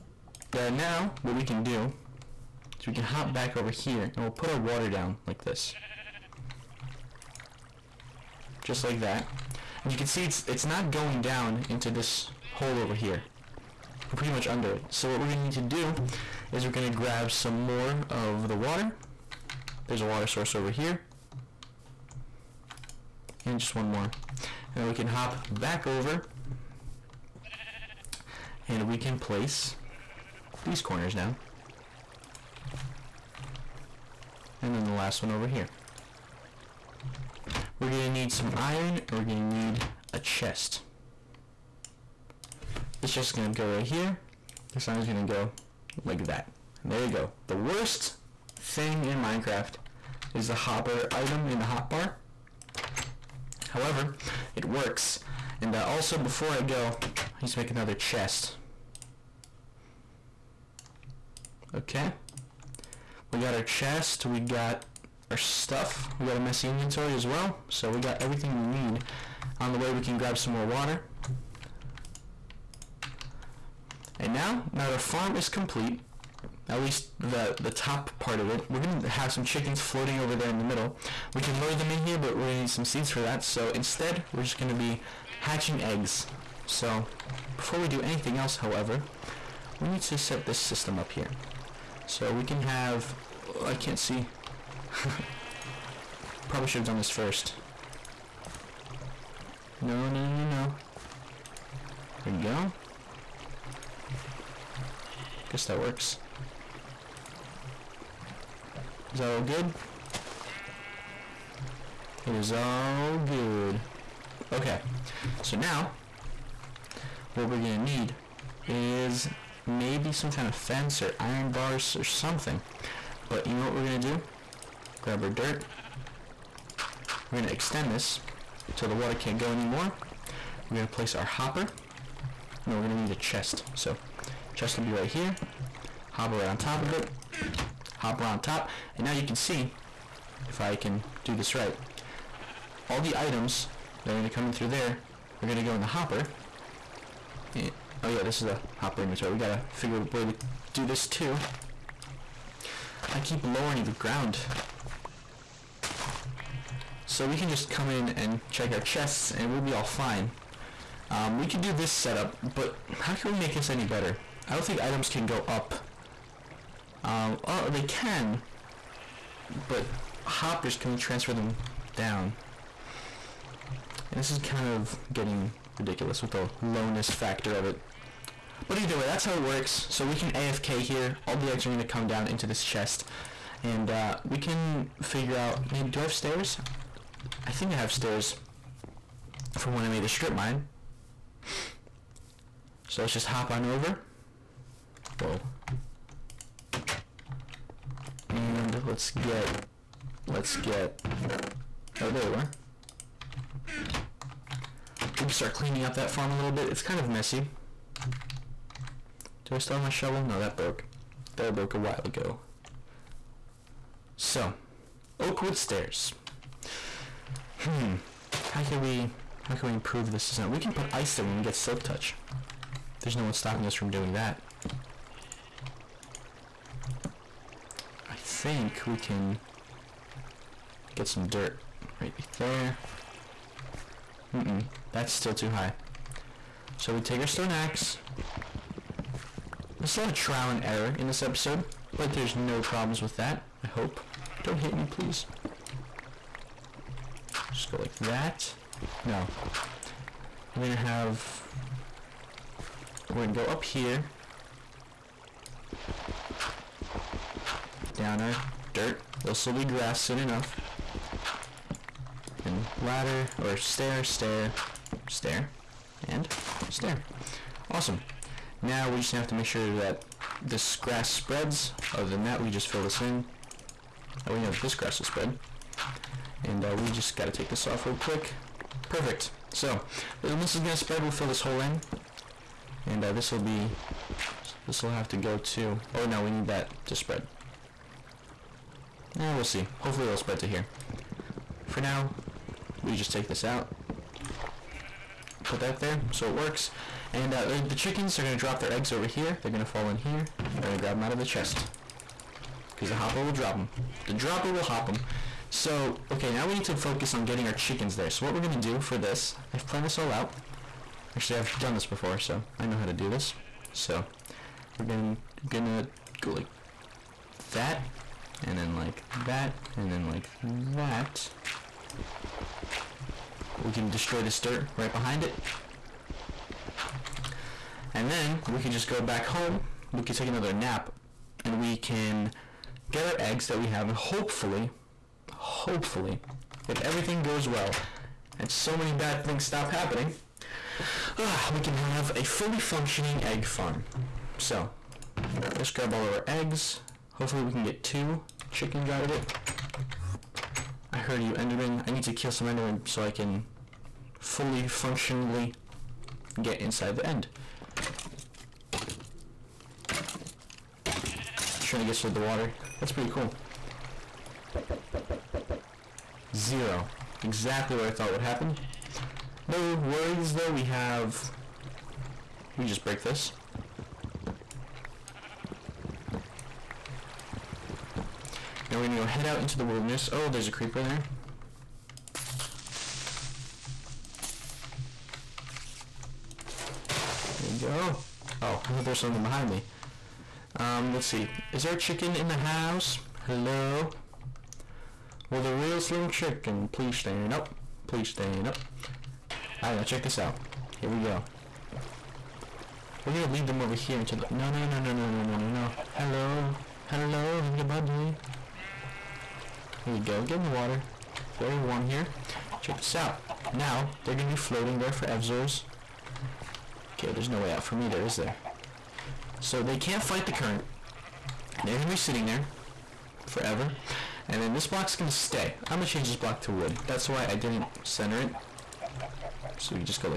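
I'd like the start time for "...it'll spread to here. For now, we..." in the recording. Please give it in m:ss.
4:50.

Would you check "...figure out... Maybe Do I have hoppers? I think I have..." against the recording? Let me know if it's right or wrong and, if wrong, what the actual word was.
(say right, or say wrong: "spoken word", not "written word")
wrong: "stairs", not "hoppers".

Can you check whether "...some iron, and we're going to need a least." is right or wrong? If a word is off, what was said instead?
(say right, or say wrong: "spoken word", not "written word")
wrong: "chest", not "least".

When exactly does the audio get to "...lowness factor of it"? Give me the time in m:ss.
2:56.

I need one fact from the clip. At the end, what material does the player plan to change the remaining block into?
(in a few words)
Wood.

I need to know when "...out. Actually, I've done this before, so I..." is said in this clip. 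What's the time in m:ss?
5:10.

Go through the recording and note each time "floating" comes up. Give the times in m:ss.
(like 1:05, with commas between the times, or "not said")
1:19, 6:54.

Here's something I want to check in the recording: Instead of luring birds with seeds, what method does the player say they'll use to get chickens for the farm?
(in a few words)
Hatching eggs.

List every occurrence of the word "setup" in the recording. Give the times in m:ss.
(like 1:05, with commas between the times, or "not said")
2:41.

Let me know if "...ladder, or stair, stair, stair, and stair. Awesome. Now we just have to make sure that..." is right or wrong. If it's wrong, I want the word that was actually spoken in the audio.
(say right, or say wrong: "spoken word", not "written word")
right.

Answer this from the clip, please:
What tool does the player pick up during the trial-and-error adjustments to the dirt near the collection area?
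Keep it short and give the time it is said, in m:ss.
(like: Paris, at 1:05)
Stone axe, at 3:57.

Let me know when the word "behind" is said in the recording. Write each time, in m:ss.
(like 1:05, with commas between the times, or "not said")
5:24, 6:29.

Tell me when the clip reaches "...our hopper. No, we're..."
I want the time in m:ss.
2:11.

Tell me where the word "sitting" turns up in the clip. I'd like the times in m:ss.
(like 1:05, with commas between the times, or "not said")
7:01.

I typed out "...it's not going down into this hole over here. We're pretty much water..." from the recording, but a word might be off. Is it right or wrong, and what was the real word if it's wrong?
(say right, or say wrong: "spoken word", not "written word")
wrong: "under", not "water".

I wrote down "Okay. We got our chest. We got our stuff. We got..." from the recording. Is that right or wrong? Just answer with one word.
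right.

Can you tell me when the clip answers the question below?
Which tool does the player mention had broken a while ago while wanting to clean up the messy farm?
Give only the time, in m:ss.
3:29.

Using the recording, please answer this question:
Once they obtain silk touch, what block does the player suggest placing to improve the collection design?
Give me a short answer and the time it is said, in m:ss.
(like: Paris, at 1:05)
Ice, at 3:40.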